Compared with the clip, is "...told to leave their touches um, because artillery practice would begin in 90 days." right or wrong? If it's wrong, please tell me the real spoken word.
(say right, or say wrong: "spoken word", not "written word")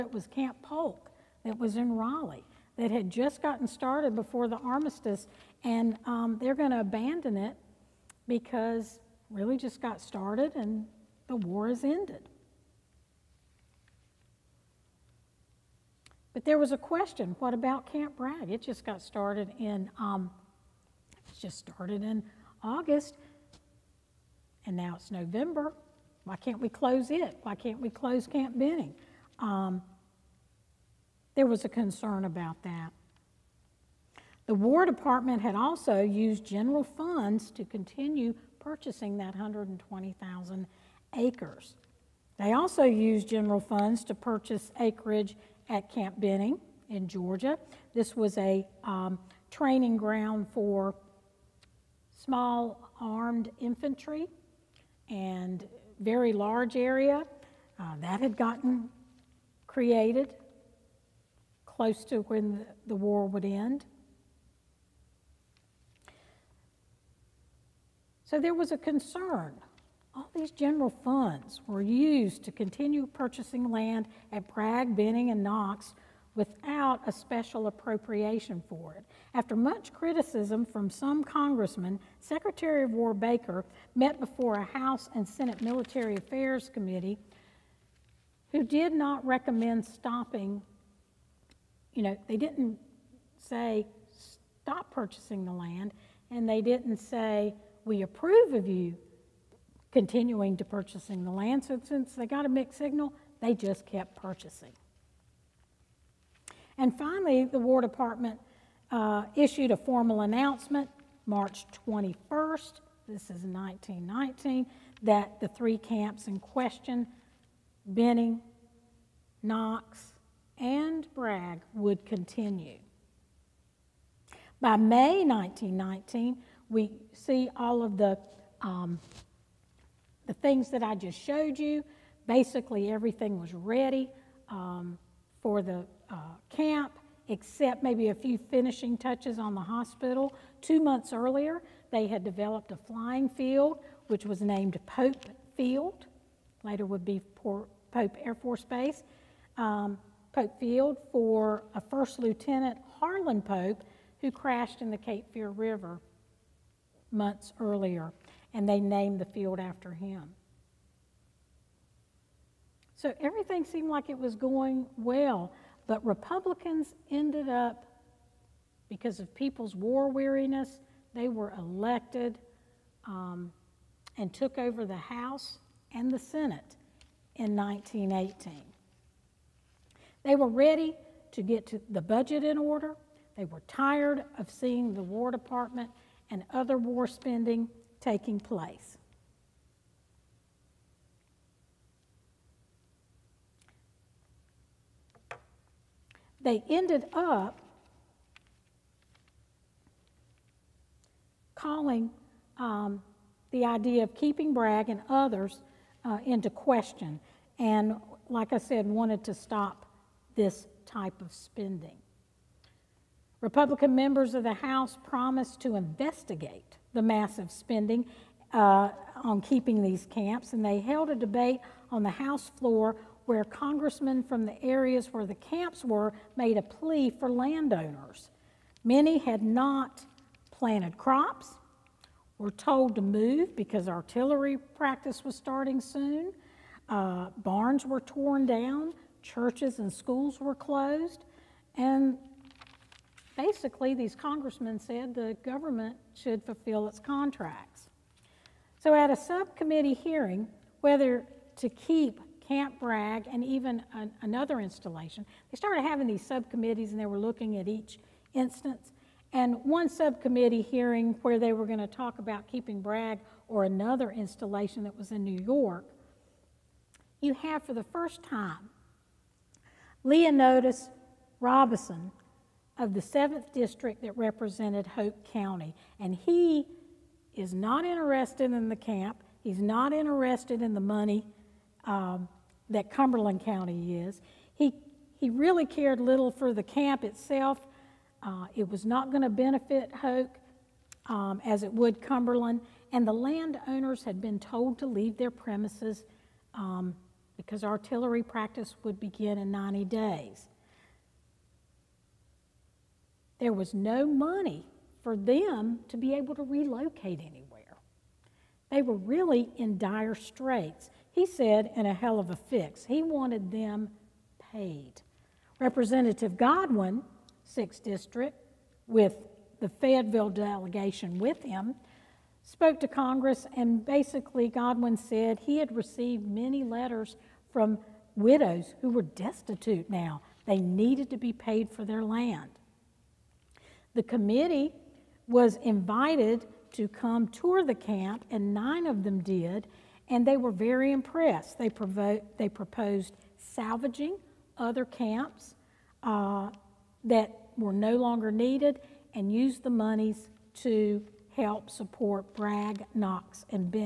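wrong: "premises", not "touches".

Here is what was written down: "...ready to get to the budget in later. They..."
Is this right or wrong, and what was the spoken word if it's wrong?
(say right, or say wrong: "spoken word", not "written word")
wrong: "order", not "later".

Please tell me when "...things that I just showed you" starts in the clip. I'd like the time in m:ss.
2:10.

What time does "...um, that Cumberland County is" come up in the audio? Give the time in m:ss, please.
4:41.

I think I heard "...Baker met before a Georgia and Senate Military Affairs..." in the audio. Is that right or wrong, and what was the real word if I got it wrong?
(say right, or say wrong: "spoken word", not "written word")
wrong: "House", not "Georgia".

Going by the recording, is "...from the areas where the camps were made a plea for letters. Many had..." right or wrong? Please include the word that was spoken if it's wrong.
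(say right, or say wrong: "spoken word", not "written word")
wrong: "landowners", not "letters".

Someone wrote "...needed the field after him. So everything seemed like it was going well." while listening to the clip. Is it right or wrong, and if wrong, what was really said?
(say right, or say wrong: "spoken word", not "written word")
wrong: "named", not "needed".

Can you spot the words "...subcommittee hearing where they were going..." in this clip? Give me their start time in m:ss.
4:19.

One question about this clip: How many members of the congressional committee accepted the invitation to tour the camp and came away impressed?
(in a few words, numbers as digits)
9.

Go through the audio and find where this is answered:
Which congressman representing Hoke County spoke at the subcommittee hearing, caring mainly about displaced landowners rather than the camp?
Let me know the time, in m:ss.
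4:30.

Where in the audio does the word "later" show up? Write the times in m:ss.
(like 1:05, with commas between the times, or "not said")
2:26.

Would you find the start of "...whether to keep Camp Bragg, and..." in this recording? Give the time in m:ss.
4:10.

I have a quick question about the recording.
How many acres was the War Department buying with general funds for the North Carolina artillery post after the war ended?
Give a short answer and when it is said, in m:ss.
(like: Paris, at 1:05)
120,000, at 0:39.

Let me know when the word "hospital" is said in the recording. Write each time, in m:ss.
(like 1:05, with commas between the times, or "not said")
2:19.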